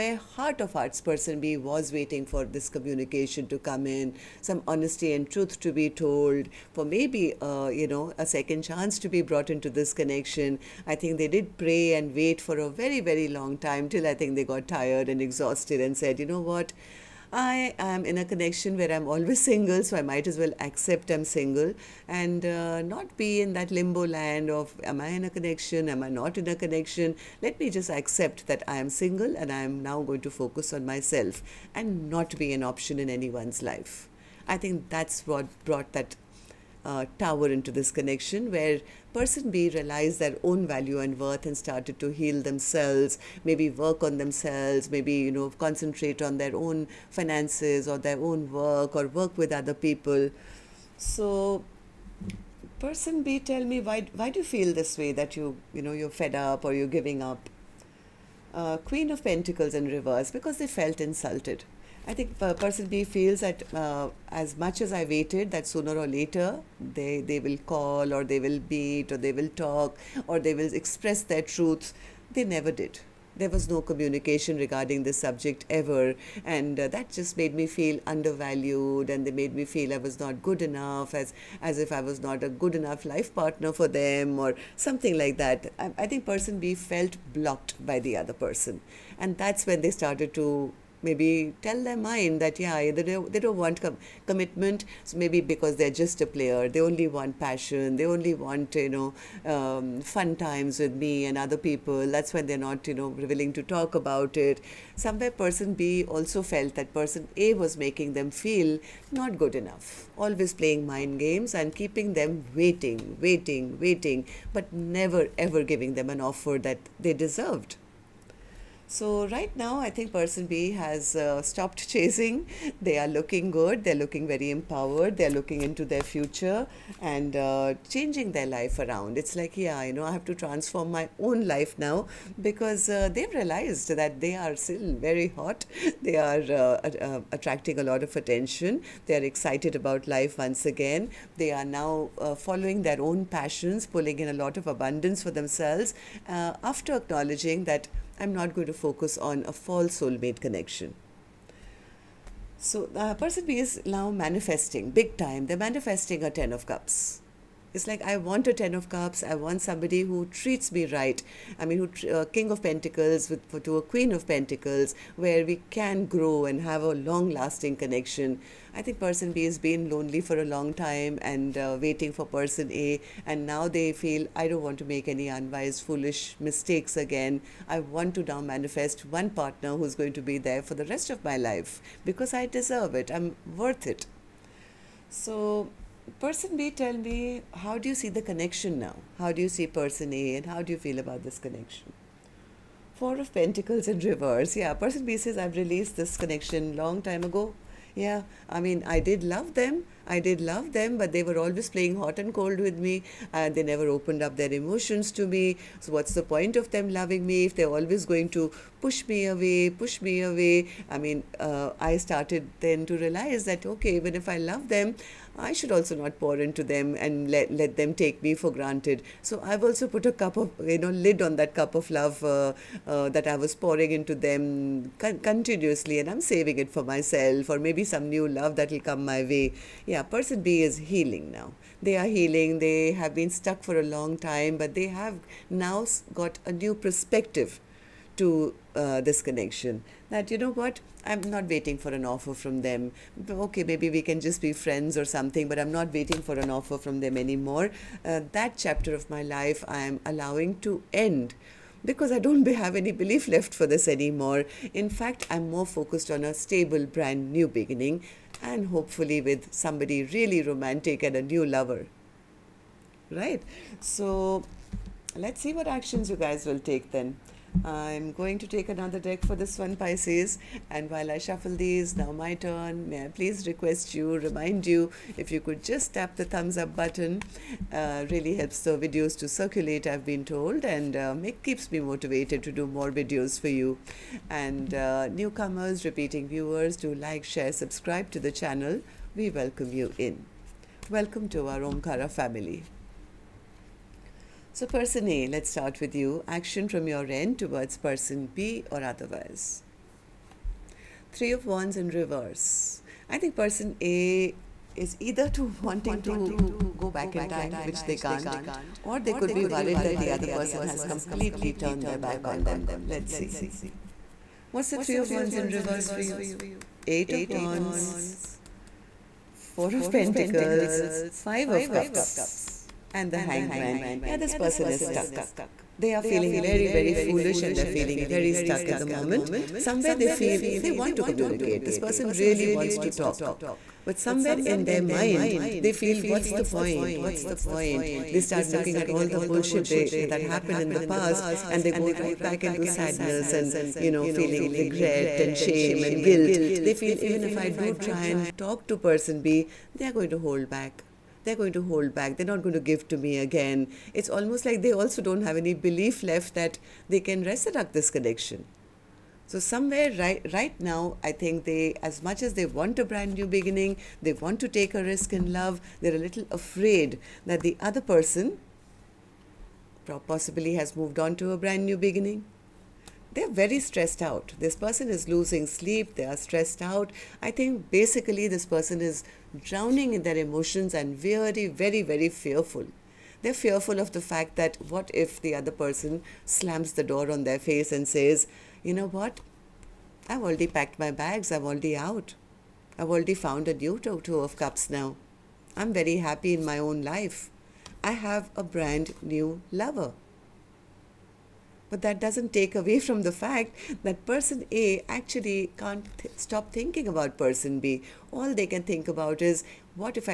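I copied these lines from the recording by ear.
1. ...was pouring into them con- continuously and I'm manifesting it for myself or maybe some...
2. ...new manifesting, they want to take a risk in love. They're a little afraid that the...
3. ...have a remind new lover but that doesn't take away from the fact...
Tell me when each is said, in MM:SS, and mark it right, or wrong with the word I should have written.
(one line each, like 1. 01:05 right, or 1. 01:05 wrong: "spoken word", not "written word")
1. 03:43 wrong: "saving", not "manifesting"
2. 06:03 wrong: "beginning", not "manifesting"
3. 06:37 wrong: "brand", not "remind".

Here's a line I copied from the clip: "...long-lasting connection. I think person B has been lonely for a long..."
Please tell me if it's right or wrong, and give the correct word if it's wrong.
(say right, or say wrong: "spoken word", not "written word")
right.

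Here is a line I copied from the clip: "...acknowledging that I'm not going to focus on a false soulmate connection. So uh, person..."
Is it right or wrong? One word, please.
right.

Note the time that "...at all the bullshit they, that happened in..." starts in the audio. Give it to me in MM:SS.
05:38.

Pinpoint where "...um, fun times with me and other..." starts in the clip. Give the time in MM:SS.
01:39.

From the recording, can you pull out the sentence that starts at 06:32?
I've already found a new two of cups now.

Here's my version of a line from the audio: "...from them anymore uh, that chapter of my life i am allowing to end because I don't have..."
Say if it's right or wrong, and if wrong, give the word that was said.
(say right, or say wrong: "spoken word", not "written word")
right.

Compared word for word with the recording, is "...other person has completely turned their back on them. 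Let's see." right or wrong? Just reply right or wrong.
right.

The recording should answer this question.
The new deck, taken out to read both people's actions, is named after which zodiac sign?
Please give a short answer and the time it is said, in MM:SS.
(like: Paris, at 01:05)
Pisces, at 04:29.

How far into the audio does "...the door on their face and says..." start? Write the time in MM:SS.
06:26.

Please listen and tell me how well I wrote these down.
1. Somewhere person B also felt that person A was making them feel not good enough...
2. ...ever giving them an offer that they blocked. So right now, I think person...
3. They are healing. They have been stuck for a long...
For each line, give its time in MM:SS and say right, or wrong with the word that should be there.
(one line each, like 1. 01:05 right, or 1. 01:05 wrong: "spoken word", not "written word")
1. 01:44 right
2. 01:55 wrong: "deserved", not "blocked"
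3. 03:51 right.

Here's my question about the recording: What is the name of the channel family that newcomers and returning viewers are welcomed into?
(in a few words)
Omkara.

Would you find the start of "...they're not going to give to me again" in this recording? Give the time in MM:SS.
05:52.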